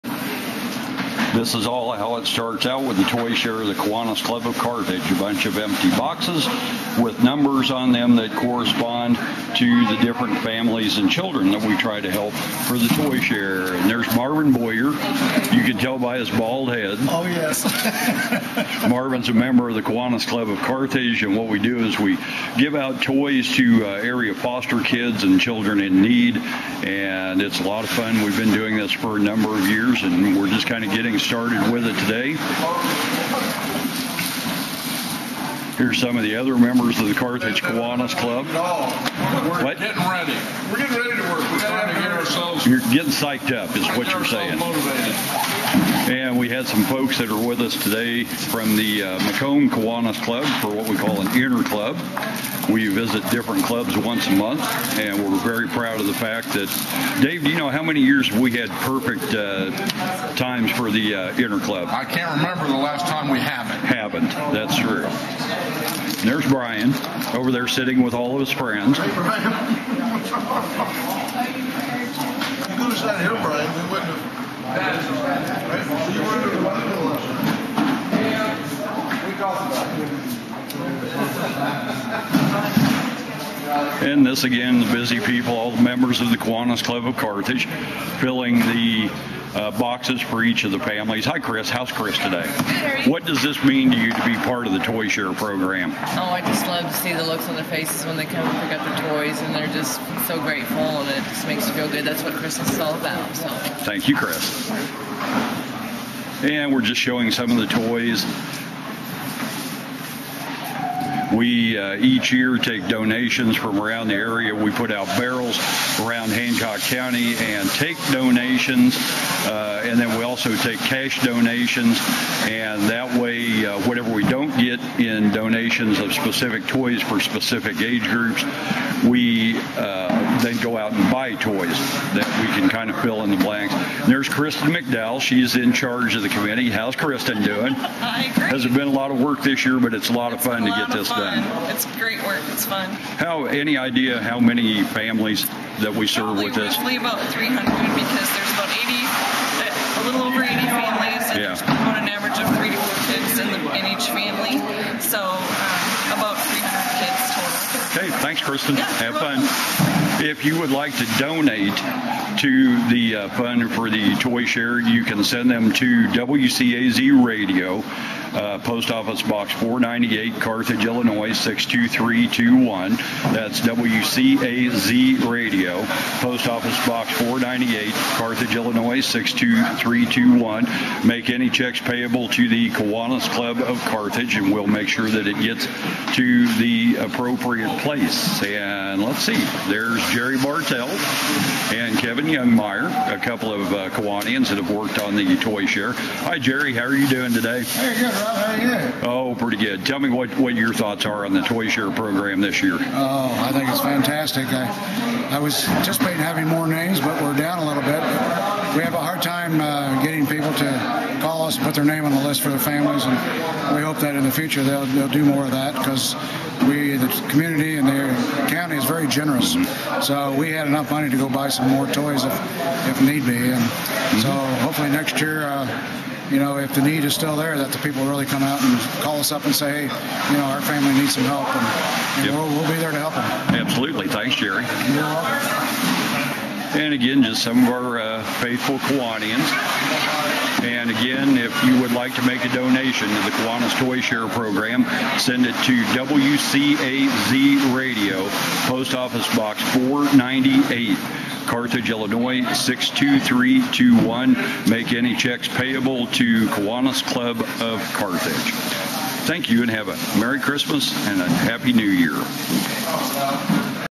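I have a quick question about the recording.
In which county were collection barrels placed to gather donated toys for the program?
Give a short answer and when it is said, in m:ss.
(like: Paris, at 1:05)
Hancock County, at 1:56.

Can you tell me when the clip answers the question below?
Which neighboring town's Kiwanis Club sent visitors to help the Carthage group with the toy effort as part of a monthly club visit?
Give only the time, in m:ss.
0:49.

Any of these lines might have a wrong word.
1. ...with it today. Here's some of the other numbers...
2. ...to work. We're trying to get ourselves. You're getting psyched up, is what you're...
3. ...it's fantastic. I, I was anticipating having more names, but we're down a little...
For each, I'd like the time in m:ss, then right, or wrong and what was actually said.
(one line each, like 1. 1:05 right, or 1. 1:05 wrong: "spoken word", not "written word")
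1. 0:31 wrong: "members", not "numbers"
2. 0:41 right
3. 3:23 right.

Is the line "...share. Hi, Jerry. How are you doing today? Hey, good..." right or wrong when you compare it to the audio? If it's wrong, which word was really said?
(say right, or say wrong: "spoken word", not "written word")
right.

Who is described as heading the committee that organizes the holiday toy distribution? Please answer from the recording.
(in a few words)
Kristen McDowell.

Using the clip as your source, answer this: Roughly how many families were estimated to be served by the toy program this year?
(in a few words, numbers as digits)
300.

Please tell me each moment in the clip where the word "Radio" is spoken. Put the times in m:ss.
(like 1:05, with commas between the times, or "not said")
2:47, 2:55, 4:07.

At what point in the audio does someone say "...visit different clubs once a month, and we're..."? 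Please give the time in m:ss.
0:52.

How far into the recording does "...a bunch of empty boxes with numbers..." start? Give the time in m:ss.
0:05.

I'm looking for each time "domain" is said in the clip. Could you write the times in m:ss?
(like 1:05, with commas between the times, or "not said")
not said.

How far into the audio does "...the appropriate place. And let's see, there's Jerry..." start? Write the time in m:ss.
3:06.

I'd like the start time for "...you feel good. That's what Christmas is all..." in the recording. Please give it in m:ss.
1:41.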